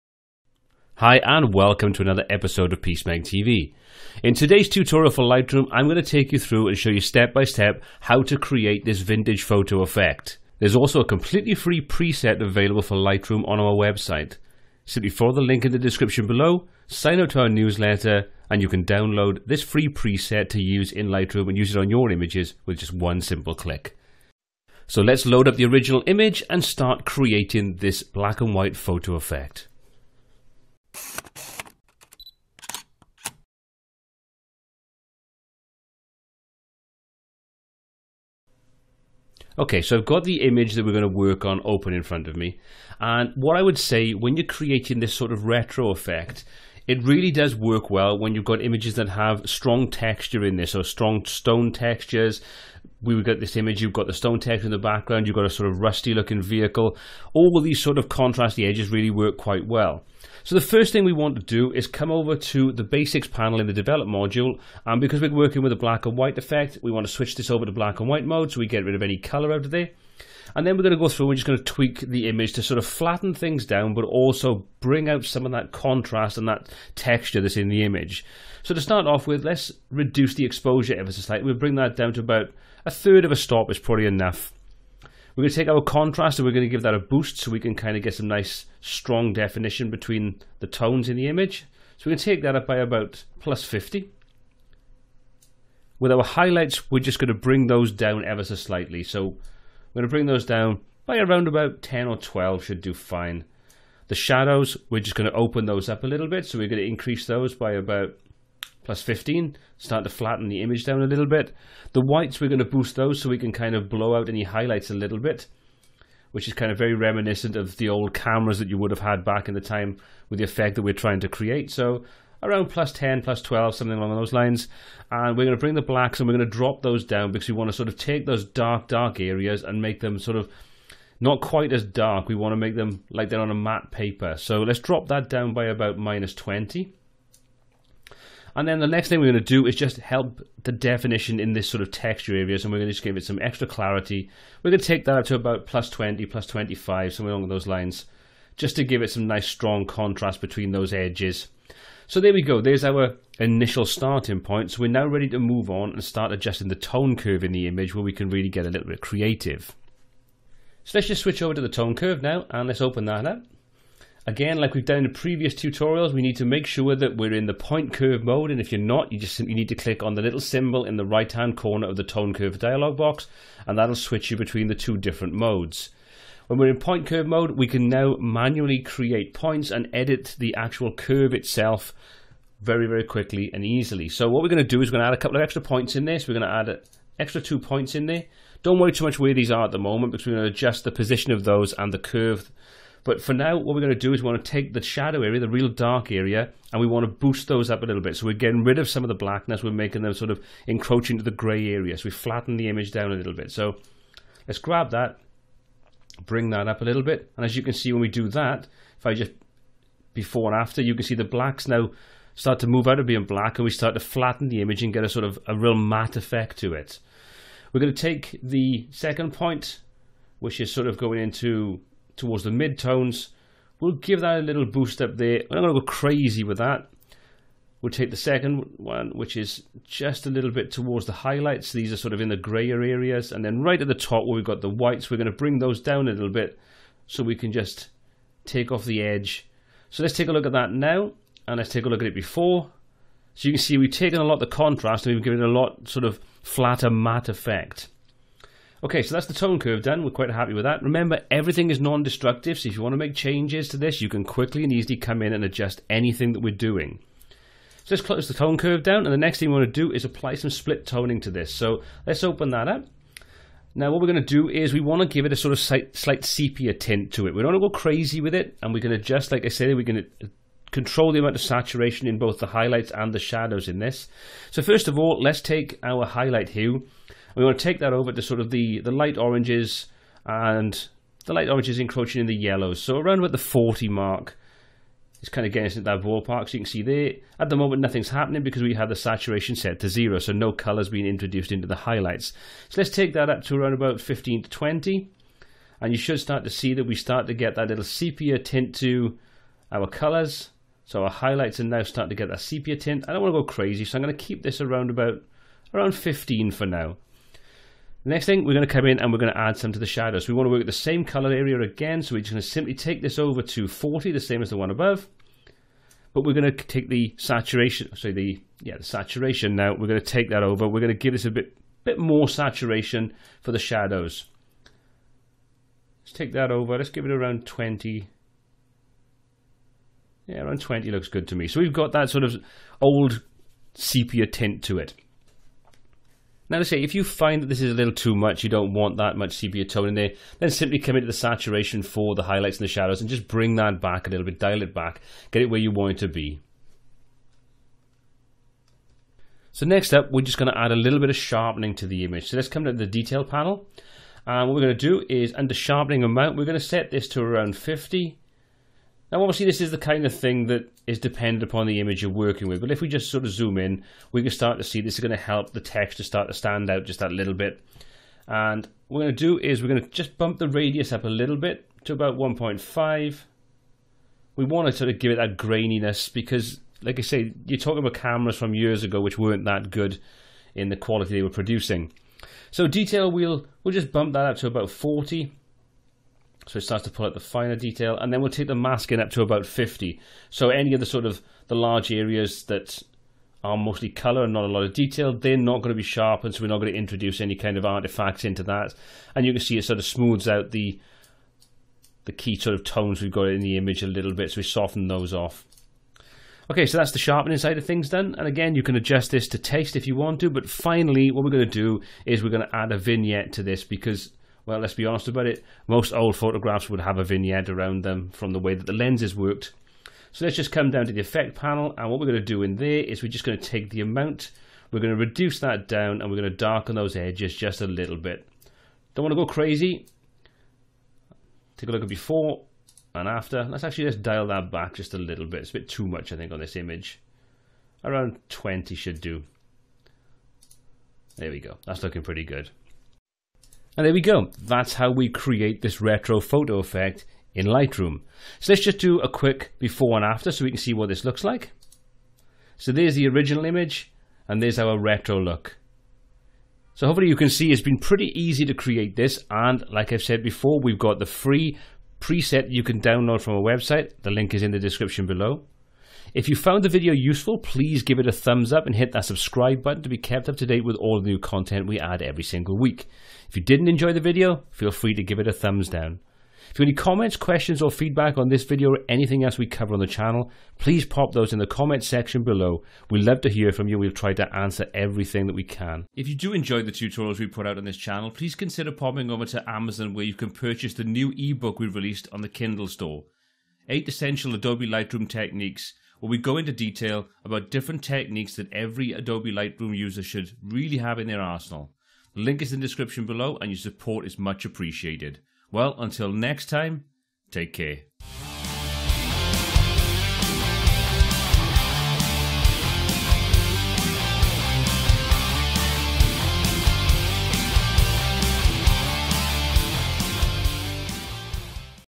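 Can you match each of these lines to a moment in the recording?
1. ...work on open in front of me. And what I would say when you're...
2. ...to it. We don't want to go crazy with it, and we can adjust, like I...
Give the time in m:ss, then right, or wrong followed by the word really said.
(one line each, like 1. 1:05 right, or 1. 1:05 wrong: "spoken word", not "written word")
1. 0:41 right
2. 4:27 right.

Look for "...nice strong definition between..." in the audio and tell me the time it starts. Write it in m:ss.
1:28.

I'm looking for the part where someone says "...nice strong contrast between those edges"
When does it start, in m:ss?
2:29.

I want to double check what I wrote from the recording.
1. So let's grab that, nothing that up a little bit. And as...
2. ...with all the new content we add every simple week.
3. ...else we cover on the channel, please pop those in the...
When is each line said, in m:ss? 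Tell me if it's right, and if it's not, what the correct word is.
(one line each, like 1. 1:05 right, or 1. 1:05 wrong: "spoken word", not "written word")
1. 3:23 wrong: "bring", not "nothing"
2. 7:50 wrong: "single", not "simple"
3. 7:59 right.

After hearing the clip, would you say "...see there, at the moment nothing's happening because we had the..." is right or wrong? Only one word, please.
right.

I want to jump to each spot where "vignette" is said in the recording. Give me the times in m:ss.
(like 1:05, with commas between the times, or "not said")
6:52, 6:57.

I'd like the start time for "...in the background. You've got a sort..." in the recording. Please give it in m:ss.
0:54.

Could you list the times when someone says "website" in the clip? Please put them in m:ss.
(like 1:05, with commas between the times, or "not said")
0:13, 7:43.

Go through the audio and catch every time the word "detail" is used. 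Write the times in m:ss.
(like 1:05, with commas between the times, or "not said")
5:52, 6:22, 6:27, 6:34, 8:16.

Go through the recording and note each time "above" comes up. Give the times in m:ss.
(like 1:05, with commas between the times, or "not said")
5:14.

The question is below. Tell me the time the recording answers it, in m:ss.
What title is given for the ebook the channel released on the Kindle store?
8:13.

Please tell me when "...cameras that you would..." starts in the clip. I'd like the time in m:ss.
1:58.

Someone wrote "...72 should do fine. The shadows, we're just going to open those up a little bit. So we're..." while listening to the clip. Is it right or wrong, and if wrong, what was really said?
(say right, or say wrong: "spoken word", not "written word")
wrong: "12", not "72".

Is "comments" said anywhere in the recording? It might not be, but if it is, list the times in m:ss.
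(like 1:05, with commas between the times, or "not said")
7:56, 8:01.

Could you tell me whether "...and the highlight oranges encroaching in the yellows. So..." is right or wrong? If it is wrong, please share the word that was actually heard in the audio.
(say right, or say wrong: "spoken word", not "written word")
wrong: "light", not "highlight".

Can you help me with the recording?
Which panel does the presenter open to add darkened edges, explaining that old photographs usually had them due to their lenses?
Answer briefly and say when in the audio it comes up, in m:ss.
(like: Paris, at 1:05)
Effect panel, at 7:01.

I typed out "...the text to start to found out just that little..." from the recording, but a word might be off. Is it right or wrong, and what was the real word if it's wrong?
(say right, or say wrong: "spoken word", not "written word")
wrong: "stand", not "found".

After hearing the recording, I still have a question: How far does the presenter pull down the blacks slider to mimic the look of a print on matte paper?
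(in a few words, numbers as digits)
-20.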